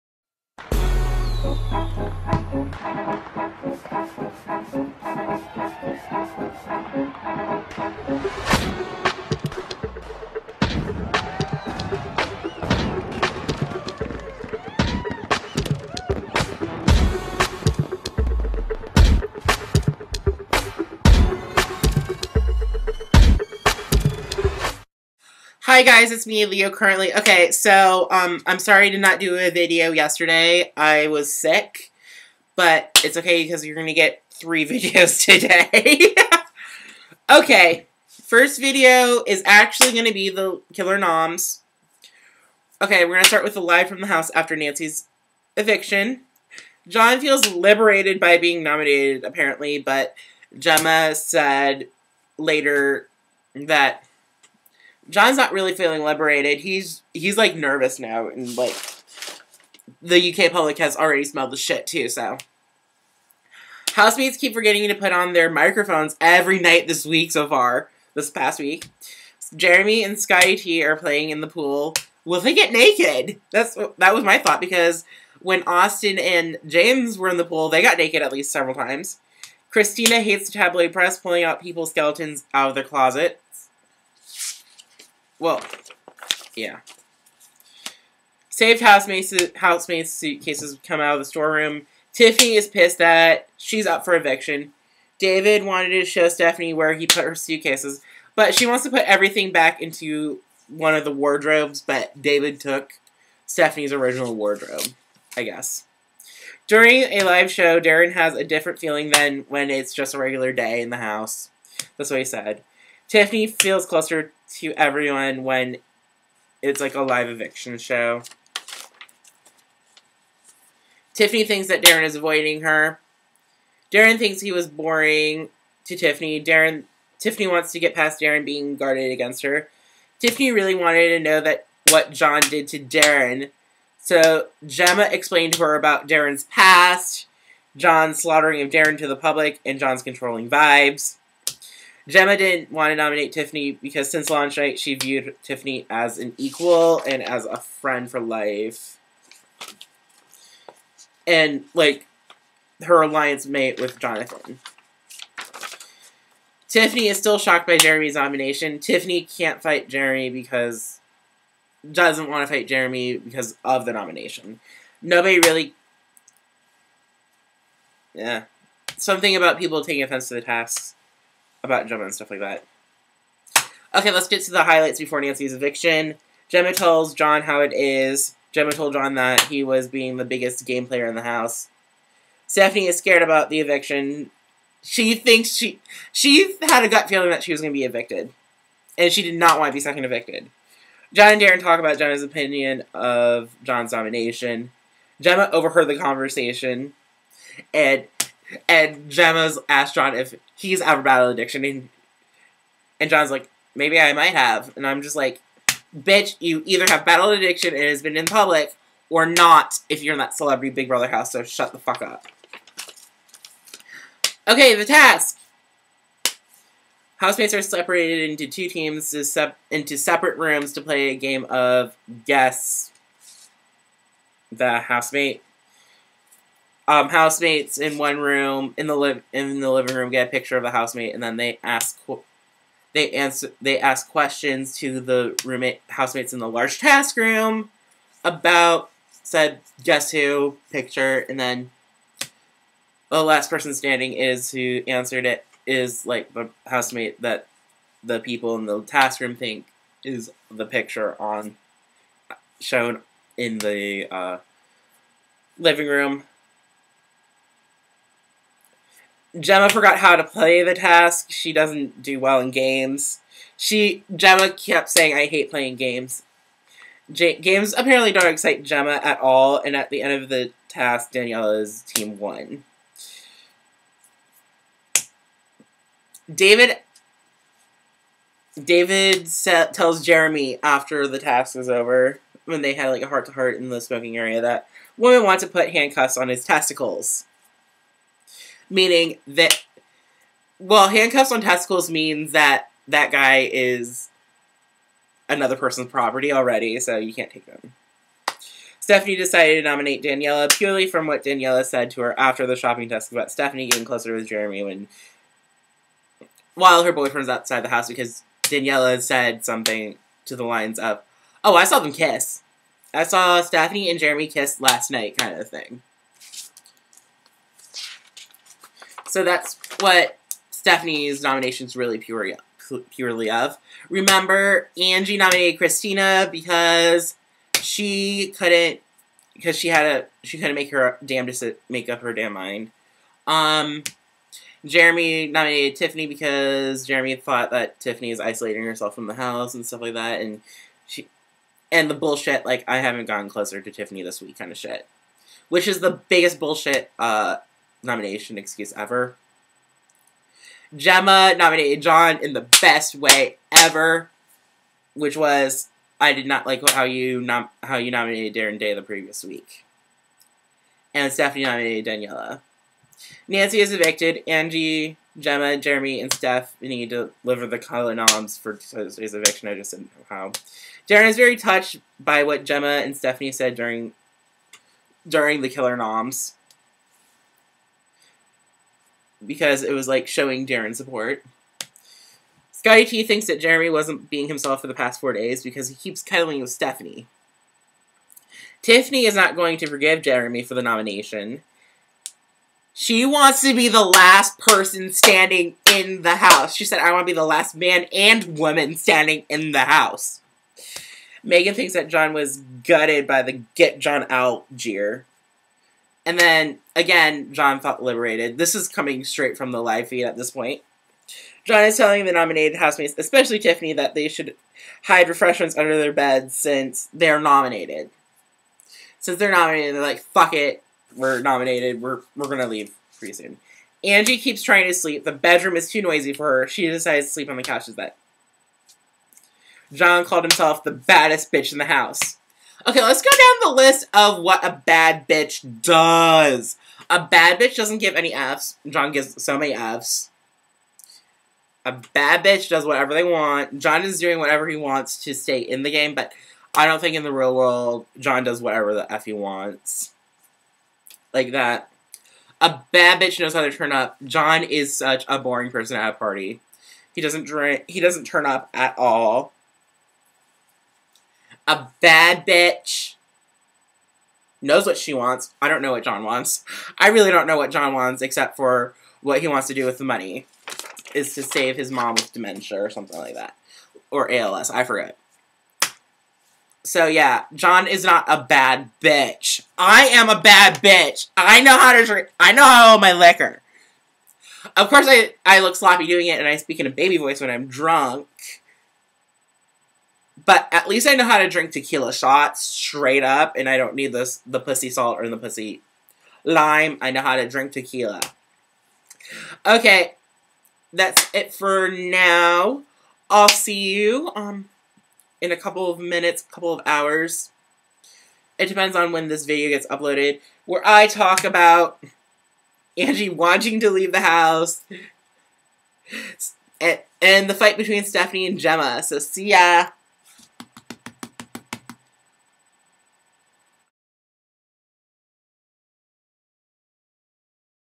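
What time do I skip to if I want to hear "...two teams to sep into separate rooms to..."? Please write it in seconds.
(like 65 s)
218 s.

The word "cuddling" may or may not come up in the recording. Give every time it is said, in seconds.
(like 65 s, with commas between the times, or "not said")
386 s.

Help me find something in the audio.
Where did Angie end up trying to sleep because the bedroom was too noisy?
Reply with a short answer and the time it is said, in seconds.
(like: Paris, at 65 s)
the couch's bed, at 427 s.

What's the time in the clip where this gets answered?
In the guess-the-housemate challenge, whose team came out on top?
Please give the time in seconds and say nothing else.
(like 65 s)
271 s.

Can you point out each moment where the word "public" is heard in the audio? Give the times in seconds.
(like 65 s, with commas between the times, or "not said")
60 s, 139 s, 208 s.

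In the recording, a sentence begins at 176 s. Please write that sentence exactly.
Gemma tells John how it is.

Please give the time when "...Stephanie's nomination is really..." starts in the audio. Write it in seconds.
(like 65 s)
320 s.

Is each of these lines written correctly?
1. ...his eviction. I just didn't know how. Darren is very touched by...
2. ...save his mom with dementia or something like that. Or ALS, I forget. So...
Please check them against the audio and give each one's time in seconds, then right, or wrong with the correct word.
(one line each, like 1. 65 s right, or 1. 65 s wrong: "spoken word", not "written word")
1. 368 s right
2. 471 s right.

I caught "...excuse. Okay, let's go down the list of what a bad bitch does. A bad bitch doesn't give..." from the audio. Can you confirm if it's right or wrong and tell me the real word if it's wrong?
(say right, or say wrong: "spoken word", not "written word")
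wrong: "house", not "excuse".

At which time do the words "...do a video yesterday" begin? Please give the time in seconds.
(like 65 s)
29 s.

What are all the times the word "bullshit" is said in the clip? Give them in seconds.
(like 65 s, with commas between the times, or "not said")
341 s, 346 s.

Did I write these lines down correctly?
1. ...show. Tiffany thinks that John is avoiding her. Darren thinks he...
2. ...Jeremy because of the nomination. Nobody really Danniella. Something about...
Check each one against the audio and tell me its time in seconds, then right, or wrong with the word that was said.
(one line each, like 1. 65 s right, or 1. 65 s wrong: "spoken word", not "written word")
1. 117 s wrong: "Darren", not "John"
2. 162 s wrong: "Yeah", not "Danniella".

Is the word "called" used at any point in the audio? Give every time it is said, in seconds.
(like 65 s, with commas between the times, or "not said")
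430 s.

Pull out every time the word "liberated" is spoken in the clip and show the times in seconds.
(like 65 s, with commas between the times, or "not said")
47 s, 56 s, 407 s.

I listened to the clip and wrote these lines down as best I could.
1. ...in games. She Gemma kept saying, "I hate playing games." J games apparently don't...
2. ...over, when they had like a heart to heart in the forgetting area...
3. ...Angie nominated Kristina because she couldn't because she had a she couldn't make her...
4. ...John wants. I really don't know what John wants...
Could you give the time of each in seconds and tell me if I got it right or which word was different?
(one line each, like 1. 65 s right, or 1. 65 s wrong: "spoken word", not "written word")
1. 262 s right
2. 281 s wrong: "smoking", not "forgetting"
3. 324 s right
4. 465 s right.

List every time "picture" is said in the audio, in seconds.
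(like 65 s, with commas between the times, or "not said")
230 s, 240 s, 250 s.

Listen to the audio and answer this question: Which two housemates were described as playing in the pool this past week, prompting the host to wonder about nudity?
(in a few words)
Jeremy and Scotty T.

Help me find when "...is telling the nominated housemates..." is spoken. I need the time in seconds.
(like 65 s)
411 s.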